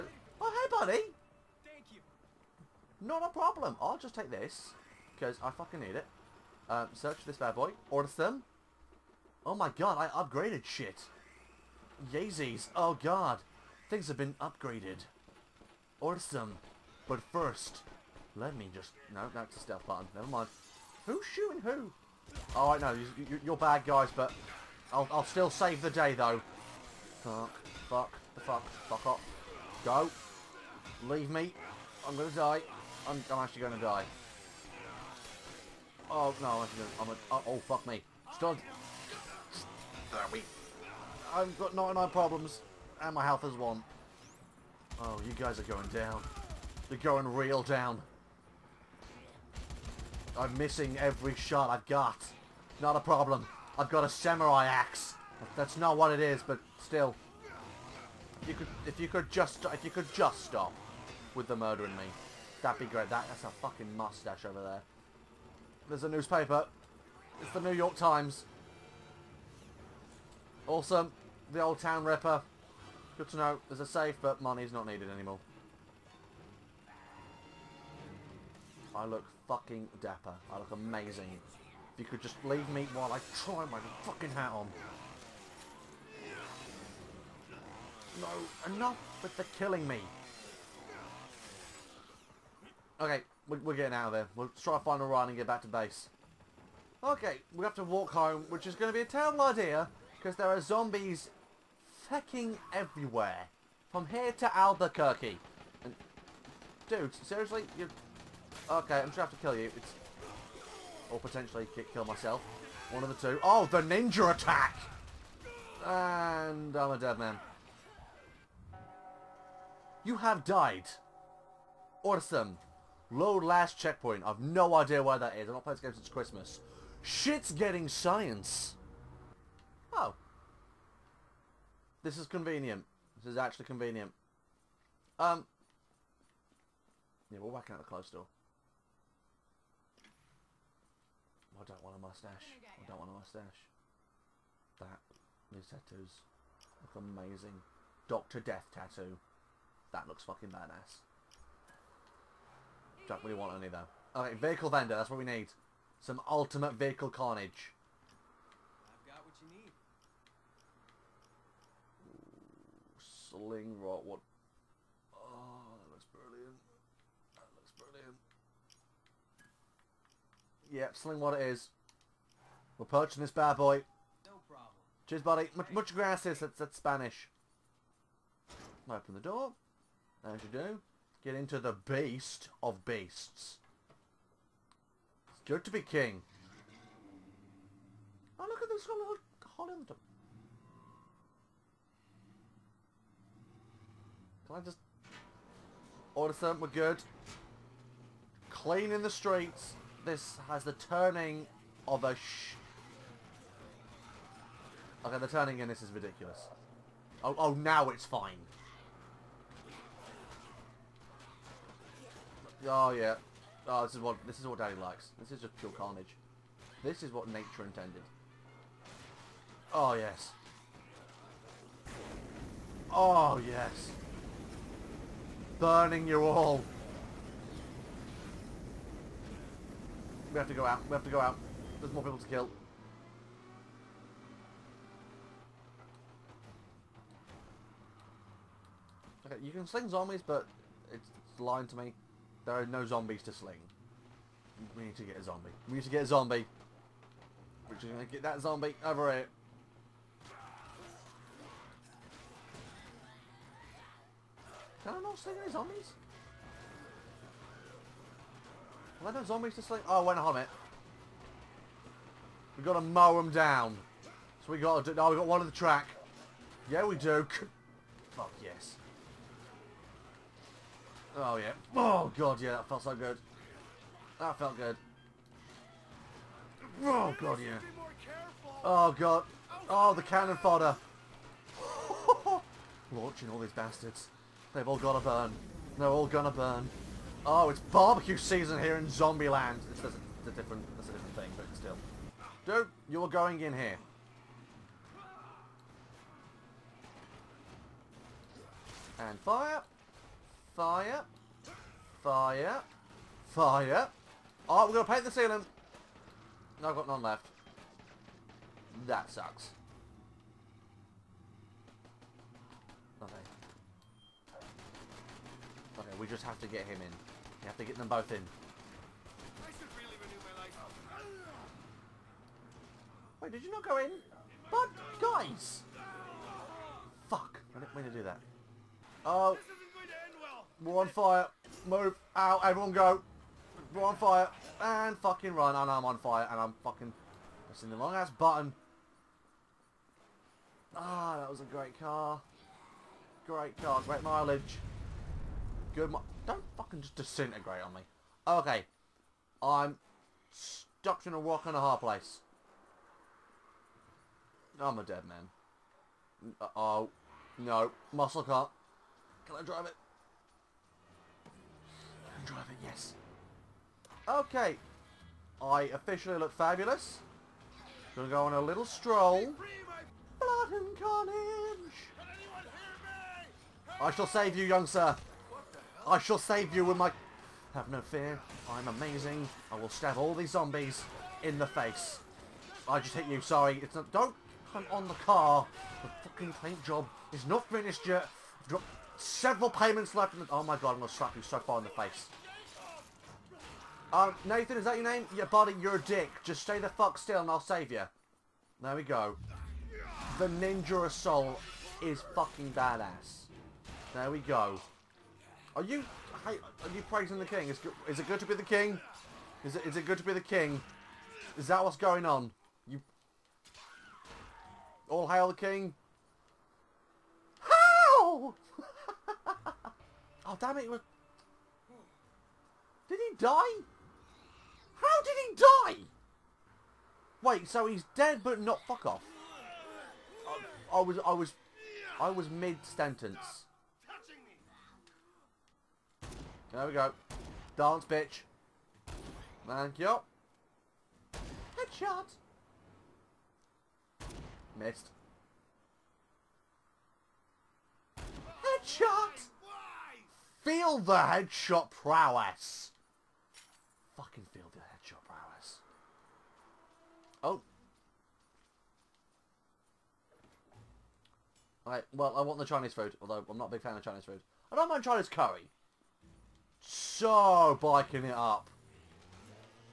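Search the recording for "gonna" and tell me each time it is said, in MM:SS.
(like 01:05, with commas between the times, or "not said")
00:36, 01:49, 04:46, 05:04, 06:07.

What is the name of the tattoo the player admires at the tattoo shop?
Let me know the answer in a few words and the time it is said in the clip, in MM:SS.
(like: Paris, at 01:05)
Doctor Death, at 02:28.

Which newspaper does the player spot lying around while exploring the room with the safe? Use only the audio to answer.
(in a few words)
The New York Times.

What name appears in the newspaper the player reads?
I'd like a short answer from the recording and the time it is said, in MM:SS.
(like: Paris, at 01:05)
The Old Town Ripper, at 01:11.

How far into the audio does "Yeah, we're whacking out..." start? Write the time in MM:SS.
02:17.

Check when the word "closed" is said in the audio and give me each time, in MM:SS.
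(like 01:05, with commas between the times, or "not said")
02:17.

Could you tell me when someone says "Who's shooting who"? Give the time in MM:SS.
00:21.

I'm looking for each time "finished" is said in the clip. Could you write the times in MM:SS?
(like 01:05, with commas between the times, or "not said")
06:27.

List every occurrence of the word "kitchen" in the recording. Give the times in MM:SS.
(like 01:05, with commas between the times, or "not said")
not said.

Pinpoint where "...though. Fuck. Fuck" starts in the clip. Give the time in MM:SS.
00:26.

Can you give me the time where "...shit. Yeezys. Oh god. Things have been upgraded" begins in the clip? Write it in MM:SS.
00:10.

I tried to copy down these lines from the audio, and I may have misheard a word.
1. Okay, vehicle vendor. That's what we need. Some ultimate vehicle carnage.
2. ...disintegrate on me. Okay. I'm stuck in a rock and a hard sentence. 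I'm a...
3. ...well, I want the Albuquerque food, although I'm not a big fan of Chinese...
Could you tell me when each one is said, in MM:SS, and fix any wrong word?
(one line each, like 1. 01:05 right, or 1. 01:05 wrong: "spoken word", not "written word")
1. 02:34 right
2. 05:46 wrong: "place", not "sentence"
3. 07:41 wrong: "Chinese", not "Albuquerque".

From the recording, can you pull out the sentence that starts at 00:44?
Oh, you guys are going down.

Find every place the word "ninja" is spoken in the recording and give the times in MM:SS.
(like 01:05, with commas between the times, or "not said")
01:53, 06:40.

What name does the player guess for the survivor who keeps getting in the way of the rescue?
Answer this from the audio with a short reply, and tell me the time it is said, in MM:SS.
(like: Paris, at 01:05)
Nathan, at 06:34.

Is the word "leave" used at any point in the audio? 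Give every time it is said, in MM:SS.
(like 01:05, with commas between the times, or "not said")
00:31, 01:22.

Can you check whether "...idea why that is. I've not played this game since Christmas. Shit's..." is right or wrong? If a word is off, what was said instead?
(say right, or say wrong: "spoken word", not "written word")
right.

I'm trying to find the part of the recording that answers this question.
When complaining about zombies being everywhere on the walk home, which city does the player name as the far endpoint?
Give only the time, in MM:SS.
01:44.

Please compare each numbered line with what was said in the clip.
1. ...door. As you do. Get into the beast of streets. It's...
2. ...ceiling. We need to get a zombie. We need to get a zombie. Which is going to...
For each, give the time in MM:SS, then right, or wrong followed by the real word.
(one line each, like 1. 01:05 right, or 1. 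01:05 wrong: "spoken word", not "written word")
1. 02:59 wrong: "beasts", not "streets"
2. 04:03 wrong: "sling", not "ceiling".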